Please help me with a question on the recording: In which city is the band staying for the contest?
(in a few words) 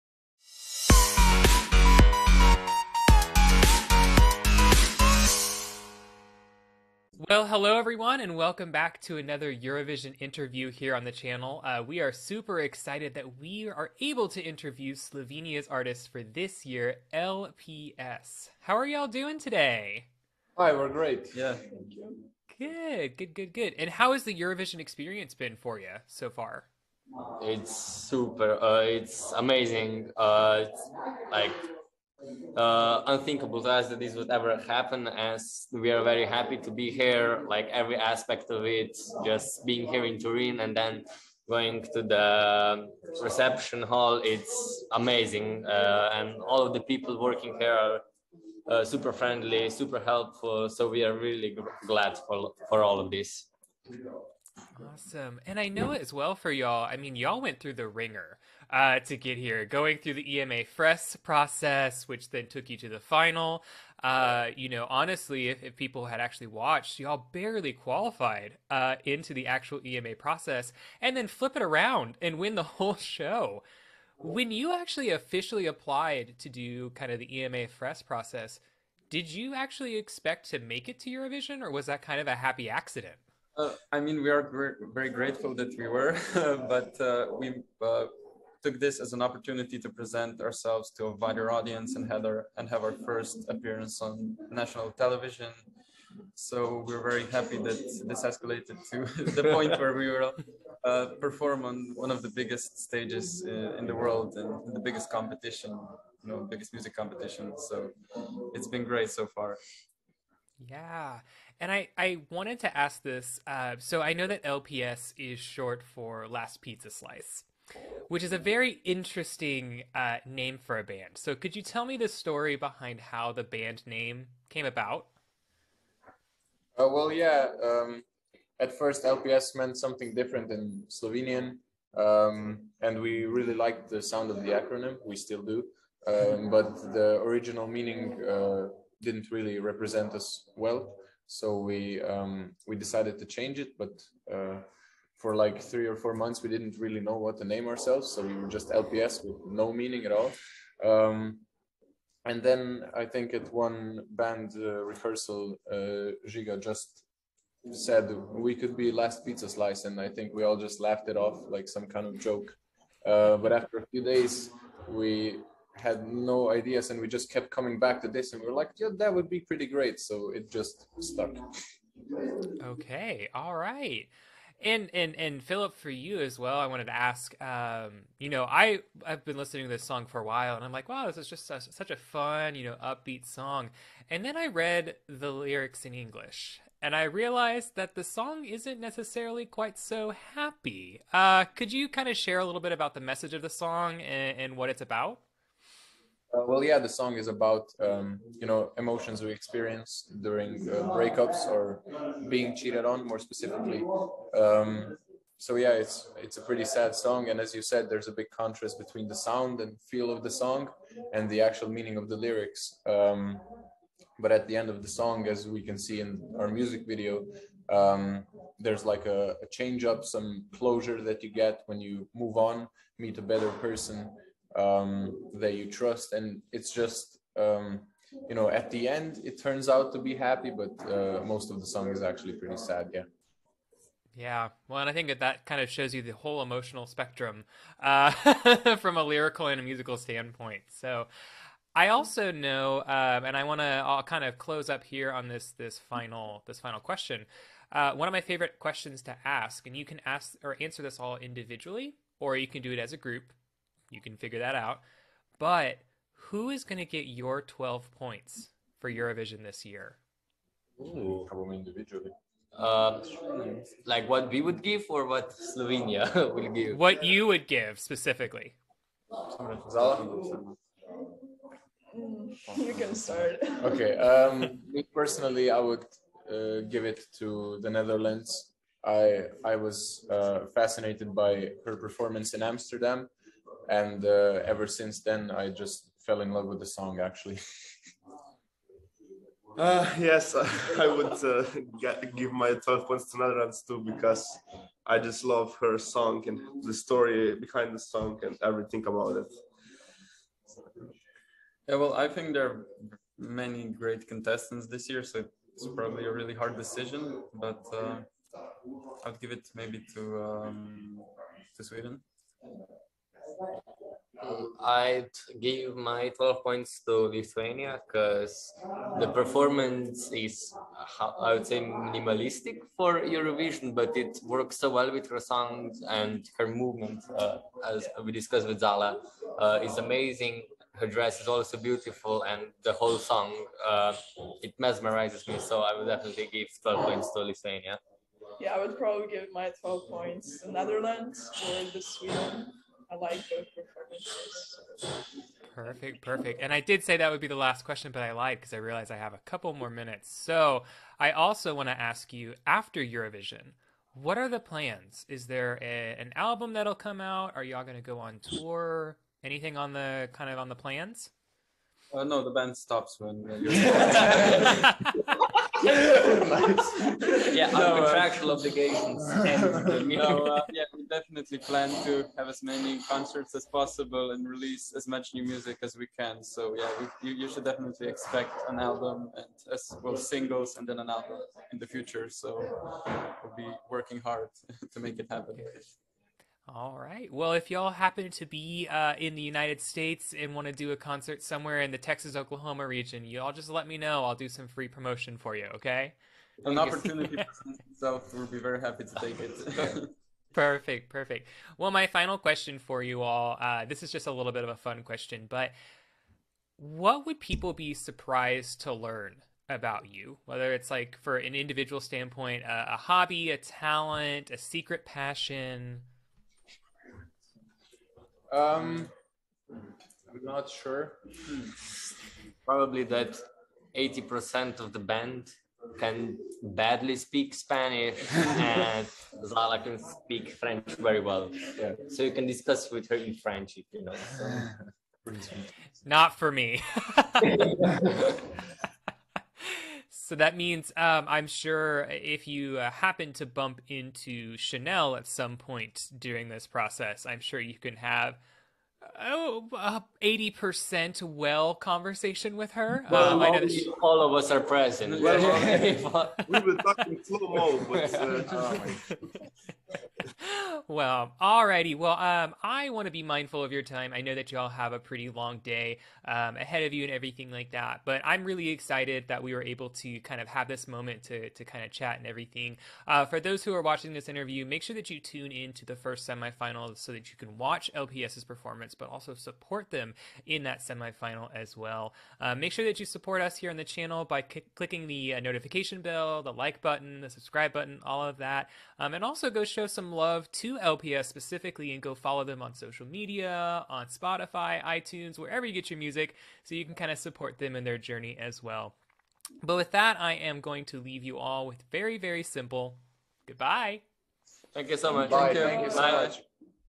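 Turin.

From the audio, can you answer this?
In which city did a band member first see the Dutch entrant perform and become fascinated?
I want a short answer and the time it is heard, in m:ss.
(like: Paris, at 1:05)
Amsterdam, at 4:42.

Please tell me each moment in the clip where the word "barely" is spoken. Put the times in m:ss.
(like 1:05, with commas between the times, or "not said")
1:07.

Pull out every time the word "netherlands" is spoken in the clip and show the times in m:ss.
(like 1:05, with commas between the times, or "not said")
4:37, 4:53, 5:40.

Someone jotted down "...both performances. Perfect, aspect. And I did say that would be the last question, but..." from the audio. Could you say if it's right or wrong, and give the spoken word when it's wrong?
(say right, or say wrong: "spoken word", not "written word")
wrong: "perfect", not "aspect".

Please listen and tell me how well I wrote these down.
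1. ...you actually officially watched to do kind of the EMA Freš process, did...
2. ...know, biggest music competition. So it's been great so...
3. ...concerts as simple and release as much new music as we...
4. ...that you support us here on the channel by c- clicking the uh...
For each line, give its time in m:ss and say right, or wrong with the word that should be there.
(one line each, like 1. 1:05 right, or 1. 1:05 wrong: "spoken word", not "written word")
1. 1:14 wrong: "applied", not "watched"
2. 1:46 right
3. 6:12 wrong: "possible", not "simple"
4. 8:02 right.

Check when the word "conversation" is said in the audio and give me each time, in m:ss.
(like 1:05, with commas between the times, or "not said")
7:31.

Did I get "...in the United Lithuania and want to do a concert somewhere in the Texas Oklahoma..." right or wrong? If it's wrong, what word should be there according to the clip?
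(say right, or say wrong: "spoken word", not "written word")
wrong: "States", not "Lithuania".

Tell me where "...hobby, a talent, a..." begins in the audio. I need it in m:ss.
6:52.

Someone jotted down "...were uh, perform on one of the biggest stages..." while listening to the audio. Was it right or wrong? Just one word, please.
right.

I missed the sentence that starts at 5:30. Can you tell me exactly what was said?
Her dress is also beautiful, and the whole song uh, it mesmerizes me.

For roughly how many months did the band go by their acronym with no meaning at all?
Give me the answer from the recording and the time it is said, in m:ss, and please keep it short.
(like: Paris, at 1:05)
3 or 4 months, at 2:25.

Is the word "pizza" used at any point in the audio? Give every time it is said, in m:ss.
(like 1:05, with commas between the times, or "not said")
1:56, 2:39.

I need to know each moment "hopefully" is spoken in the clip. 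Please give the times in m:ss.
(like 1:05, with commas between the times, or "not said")
not said.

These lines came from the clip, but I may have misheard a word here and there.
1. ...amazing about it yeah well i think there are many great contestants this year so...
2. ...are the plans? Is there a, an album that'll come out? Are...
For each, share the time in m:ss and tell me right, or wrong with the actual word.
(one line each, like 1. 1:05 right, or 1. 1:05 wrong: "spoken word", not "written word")
1. 4:58 wrong: "everything", not "amazing"
2. 5:54 right.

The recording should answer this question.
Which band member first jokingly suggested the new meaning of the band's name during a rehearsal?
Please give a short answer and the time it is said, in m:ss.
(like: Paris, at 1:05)
Žiga, at 2:36.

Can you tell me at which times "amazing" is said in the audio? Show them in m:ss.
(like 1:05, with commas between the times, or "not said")
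0:29, 0:44, 5:29.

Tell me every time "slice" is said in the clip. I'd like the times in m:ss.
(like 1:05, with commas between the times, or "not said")
1:56, 2:39.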